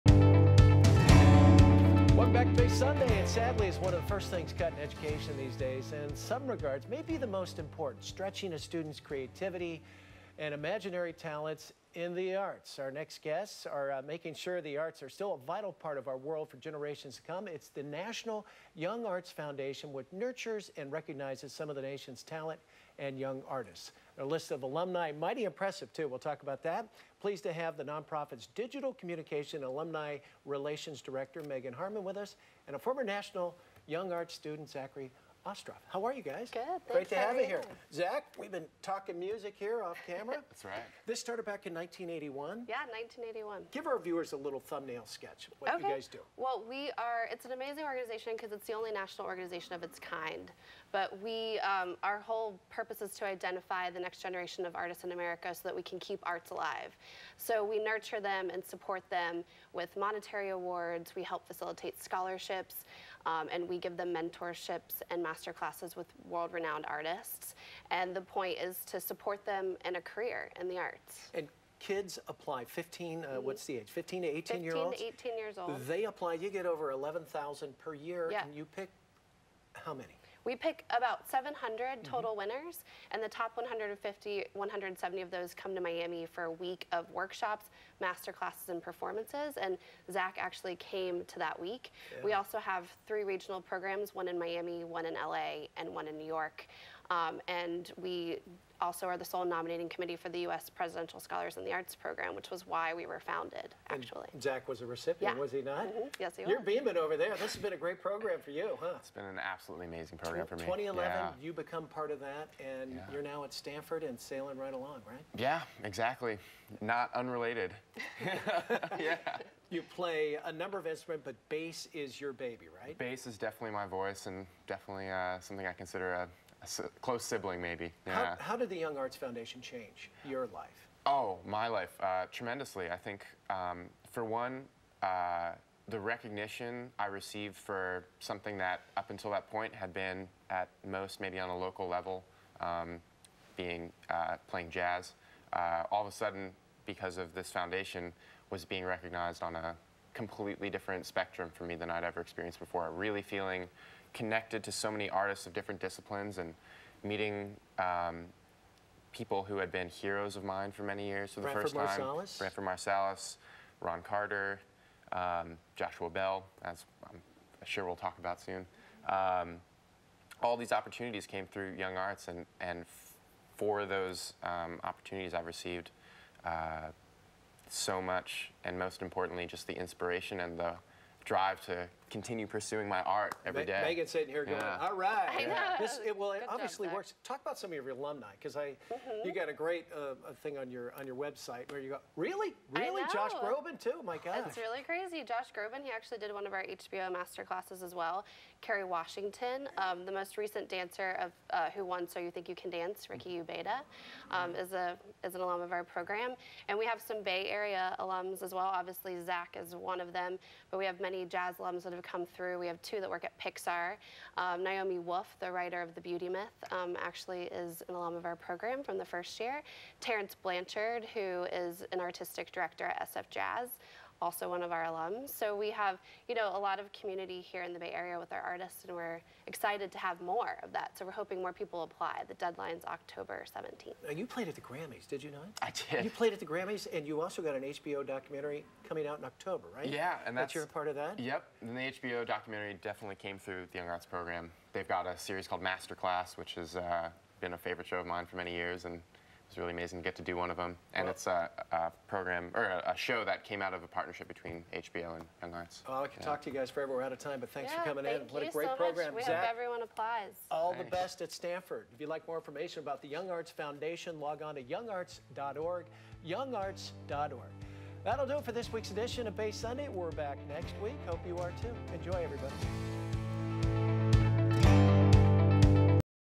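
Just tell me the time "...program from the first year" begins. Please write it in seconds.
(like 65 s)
218 s.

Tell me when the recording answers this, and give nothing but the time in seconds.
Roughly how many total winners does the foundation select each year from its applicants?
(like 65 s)
81 s.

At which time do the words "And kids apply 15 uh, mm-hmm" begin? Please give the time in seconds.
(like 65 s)
71 s.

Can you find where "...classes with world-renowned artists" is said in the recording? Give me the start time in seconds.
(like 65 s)
65 s.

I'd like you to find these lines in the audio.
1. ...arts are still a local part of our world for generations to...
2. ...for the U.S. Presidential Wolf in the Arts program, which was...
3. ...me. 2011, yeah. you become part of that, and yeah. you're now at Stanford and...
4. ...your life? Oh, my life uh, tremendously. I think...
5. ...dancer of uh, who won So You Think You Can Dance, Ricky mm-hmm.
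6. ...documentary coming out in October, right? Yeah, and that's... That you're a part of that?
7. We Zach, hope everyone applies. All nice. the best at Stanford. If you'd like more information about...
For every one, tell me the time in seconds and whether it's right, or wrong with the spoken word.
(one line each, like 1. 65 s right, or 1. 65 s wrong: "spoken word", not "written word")
1. 14 s wrong: "vital", not "local"
2. 100 s wrong: "Scholars", not "Wolf"
3. 110 s right
4. 130 s right
5. 200 s right
6. 238 s right
7. 259 s right.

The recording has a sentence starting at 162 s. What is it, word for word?
Marcellus, Marsalis, Ron Carter, um, Joshua Bell, as um, I'm sure we'll talk about soon.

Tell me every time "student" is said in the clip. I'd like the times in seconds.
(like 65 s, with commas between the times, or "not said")
8 s, 34 s.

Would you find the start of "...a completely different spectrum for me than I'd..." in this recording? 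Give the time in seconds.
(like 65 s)
149 s.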